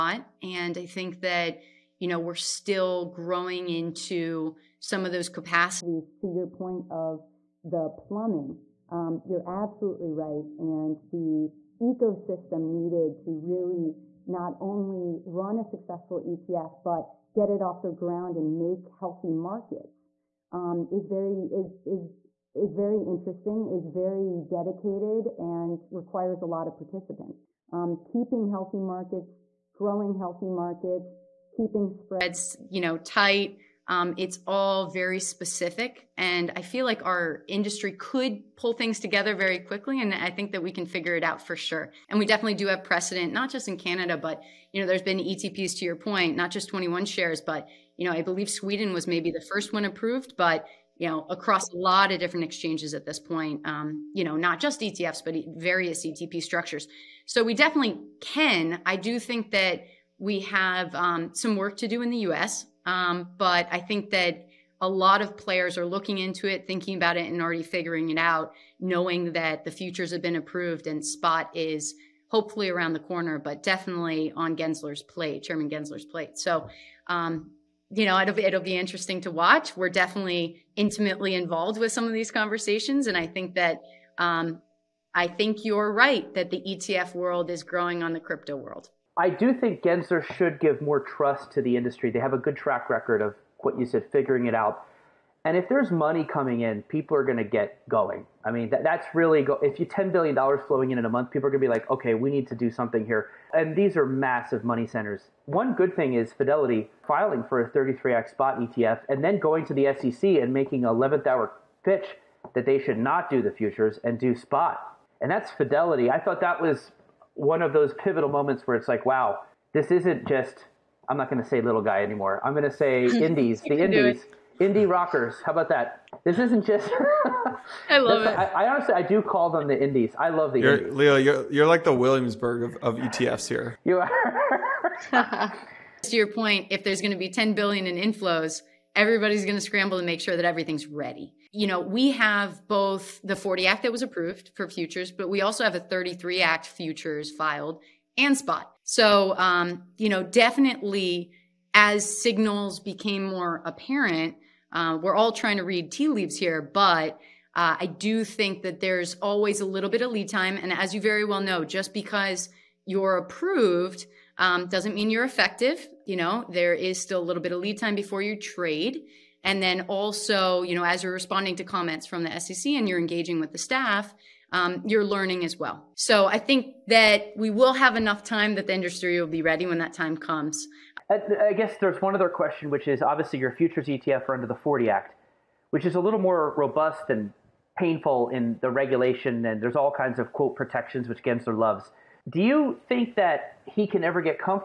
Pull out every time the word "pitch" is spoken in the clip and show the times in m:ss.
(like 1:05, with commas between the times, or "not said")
1:51.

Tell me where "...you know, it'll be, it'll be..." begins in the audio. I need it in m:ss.
1:17.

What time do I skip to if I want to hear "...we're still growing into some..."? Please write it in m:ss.
0:02.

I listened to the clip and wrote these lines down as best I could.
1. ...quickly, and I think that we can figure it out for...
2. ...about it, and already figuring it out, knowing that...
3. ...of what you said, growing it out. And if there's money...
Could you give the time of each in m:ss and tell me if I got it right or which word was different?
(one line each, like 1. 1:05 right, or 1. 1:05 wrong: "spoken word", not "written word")
1. 0:39 right
2. 1:06 right
3. 1:33 wrong: "figuring", not "growing".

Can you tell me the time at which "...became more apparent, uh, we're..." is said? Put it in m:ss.
2:32.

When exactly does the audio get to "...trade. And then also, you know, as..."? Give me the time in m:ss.
2:48.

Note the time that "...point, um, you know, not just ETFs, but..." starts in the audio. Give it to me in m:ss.
0:53.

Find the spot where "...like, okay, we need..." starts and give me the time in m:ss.
1:41.